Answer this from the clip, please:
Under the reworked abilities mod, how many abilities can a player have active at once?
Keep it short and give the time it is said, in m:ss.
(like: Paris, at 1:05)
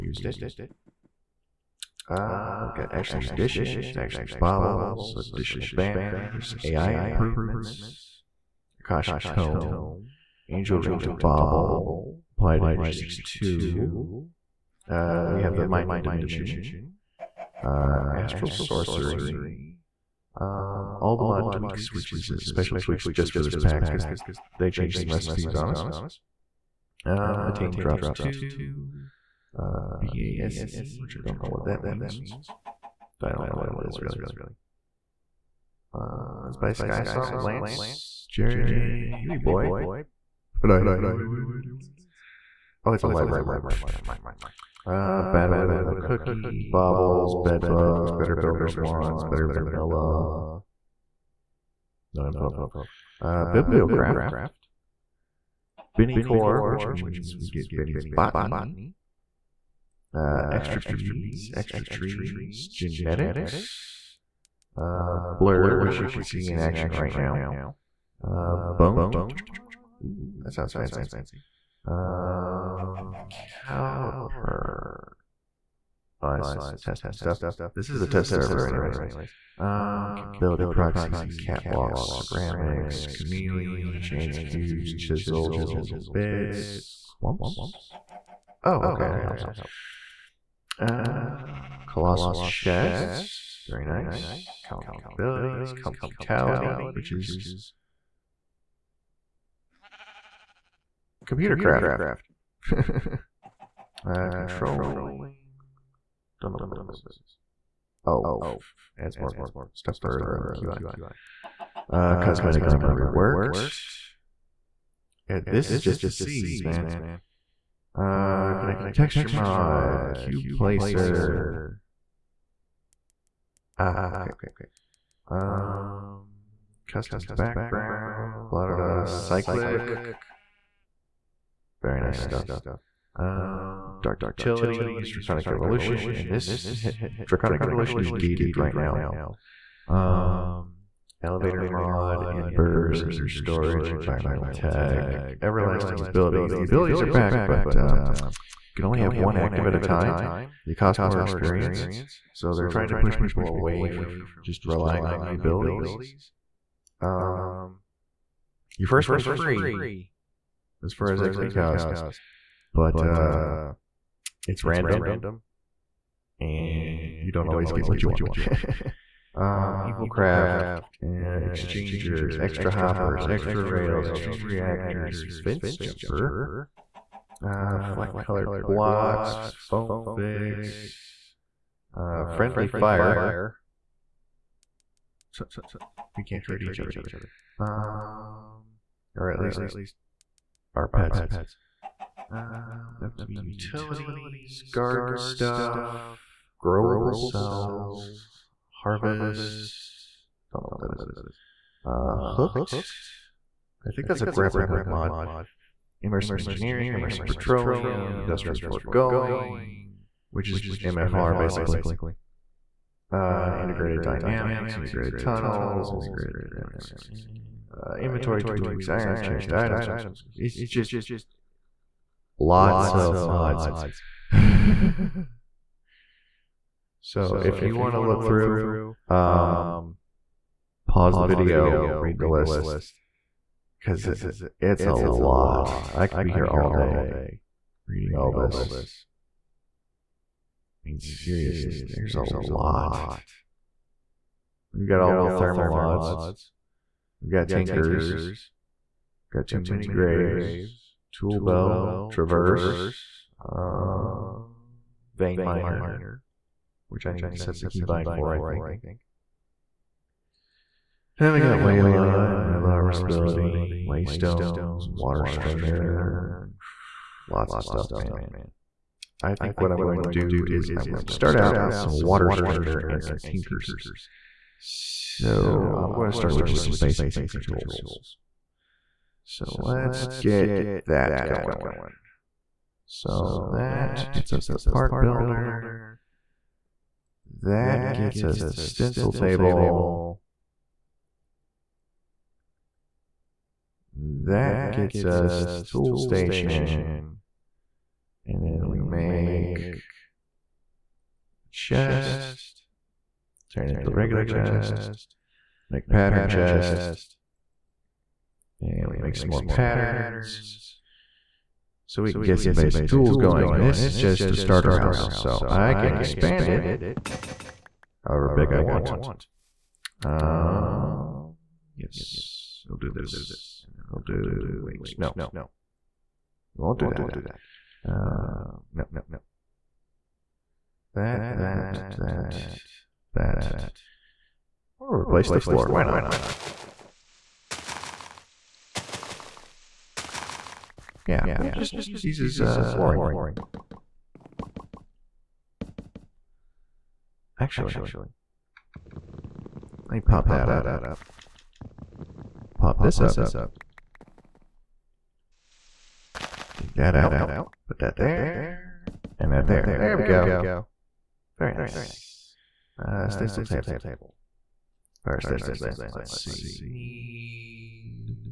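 1, at 2:28.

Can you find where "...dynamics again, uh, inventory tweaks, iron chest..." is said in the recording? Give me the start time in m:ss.
3:36.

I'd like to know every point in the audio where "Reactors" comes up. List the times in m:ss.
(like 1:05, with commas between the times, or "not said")
2:54.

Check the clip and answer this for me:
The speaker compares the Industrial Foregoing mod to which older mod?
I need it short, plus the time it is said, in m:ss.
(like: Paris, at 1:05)
MFR, at 3:30.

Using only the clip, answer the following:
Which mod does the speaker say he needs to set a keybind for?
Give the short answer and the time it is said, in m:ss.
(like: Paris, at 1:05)
Vein Miner, at 4:15.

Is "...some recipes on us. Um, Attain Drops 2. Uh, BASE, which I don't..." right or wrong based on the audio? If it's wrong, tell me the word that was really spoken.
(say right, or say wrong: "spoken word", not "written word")
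right.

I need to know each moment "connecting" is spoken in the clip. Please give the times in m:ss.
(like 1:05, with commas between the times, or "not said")
1:58.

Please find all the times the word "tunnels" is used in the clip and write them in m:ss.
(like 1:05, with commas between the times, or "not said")
3:35.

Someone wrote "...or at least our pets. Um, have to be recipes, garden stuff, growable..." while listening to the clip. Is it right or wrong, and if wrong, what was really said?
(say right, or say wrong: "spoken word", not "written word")
wrong: "utilities", not "recipes".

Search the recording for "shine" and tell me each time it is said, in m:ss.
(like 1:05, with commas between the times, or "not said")
not said.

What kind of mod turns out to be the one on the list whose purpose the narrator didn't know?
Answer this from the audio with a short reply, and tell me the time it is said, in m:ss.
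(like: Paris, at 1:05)
A library mod, at 0:43.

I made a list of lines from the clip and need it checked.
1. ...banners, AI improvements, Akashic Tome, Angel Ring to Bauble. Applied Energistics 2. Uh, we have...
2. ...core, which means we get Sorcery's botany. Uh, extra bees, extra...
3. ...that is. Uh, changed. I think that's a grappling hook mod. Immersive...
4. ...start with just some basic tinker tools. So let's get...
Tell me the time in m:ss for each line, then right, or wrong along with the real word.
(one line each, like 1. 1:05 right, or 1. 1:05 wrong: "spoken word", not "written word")
1. 0:05 right
2. 0:56 wrong: "Binnie", not "Sorcery"
3. 3:20 wrong: "hooked", not "changed"
4. 4:36 right.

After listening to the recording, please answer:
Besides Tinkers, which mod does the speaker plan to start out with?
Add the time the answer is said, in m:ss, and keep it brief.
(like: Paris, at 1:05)
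Water Strainer, at 4:31.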